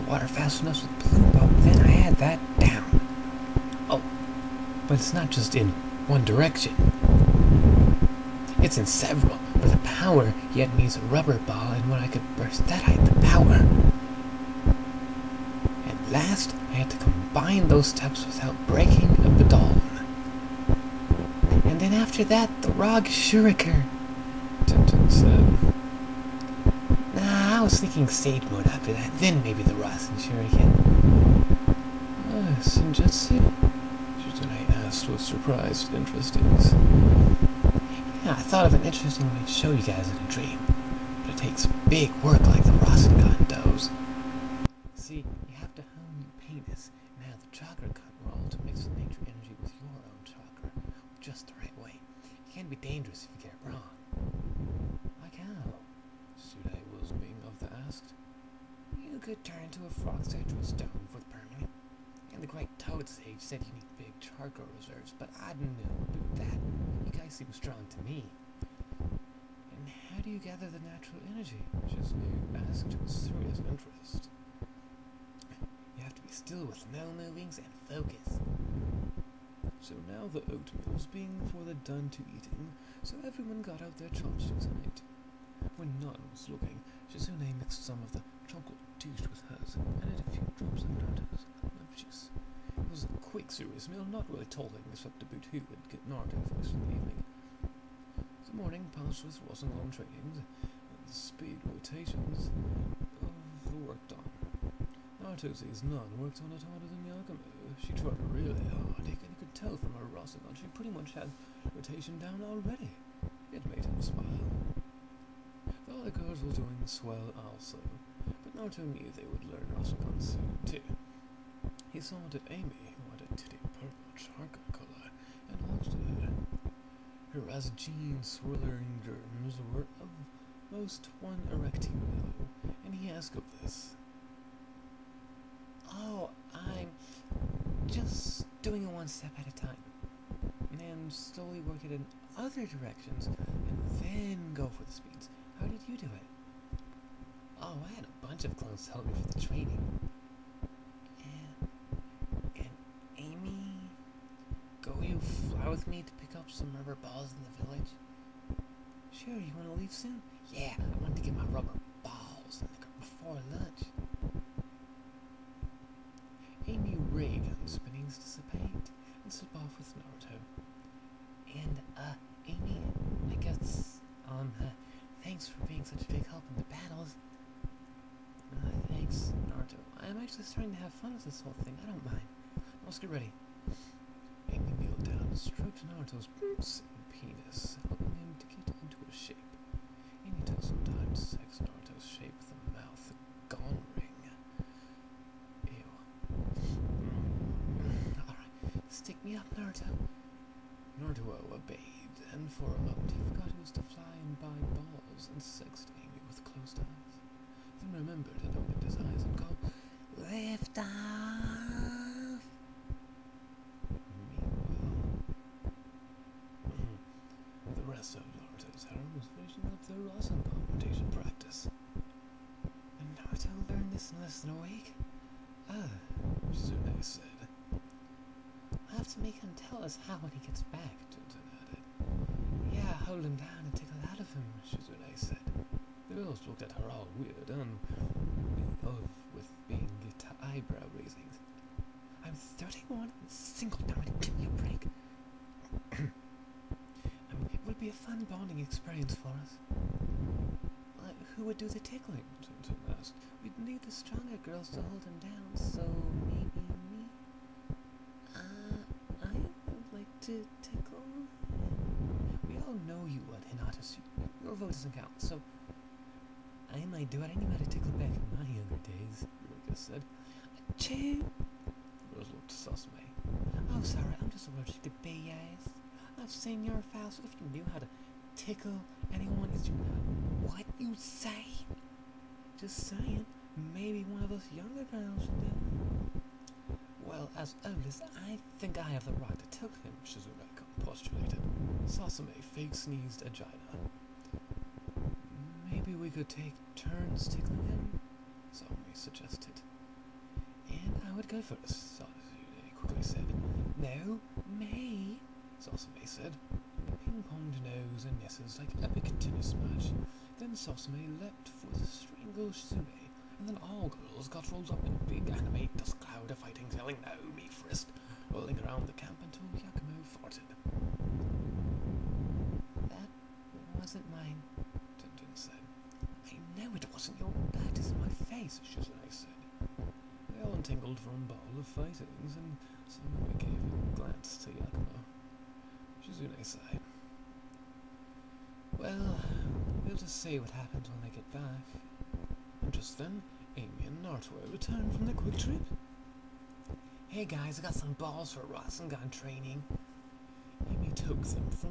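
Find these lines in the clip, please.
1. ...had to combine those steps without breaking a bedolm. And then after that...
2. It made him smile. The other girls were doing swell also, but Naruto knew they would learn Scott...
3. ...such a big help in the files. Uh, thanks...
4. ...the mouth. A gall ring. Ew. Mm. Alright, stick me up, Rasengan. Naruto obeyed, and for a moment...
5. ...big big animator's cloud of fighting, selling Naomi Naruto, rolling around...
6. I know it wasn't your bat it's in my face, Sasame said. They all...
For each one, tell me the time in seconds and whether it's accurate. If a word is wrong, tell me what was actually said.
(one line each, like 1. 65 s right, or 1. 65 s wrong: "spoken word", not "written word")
1. 16 s right
2. 113 s wrong: "Rasengan", not "Scott"
3. 175 s wrong: "battles", not "files"
4. 192 s wrong: "Naruto", not "Rasengan"
5. 315 s wrong: "Frist", not "Naruto"
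6. 326 s wrong: "Shizune", not "Sasame".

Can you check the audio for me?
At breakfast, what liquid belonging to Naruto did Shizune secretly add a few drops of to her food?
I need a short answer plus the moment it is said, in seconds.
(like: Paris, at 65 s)
Lemon juice, at 91 s.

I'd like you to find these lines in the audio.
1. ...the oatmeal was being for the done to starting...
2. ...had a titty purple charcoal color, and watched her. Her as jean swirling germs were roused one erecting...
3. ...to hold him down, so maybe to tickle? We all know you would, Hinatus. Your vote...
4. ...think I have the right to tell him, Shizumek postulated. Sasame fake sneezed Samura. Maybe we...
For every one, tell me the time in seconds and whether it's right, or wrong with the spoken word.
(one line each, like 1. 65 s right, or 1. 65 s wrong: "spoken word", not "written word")
1. 80 s wrong: "eating", not "starting"
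2. 123 s right
3. 254 s right
4. 288 s wrong: "Agina", not "Samura".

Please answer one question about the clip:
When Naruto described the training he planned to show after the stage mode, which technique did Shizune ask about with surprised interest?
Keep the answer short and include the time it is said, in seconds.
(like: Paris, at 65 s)
Senjutsu, at 32 s.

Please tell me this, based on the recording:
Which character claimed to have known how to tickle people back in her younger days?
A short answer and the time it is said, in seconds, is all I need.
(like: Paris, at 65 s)
Ruka, at 269 s.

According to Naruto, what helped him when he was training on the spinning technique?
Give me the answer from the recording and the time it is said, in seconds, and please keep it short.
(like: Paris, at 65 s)
A bunch of clones, at 148 s.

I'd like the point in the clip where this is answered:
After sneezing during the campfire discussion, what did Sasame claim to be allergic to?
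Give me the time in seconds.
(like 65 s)
275 s.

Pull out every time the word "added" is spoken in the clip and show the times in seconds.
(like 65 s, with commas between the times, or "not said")
90 s, 231 s.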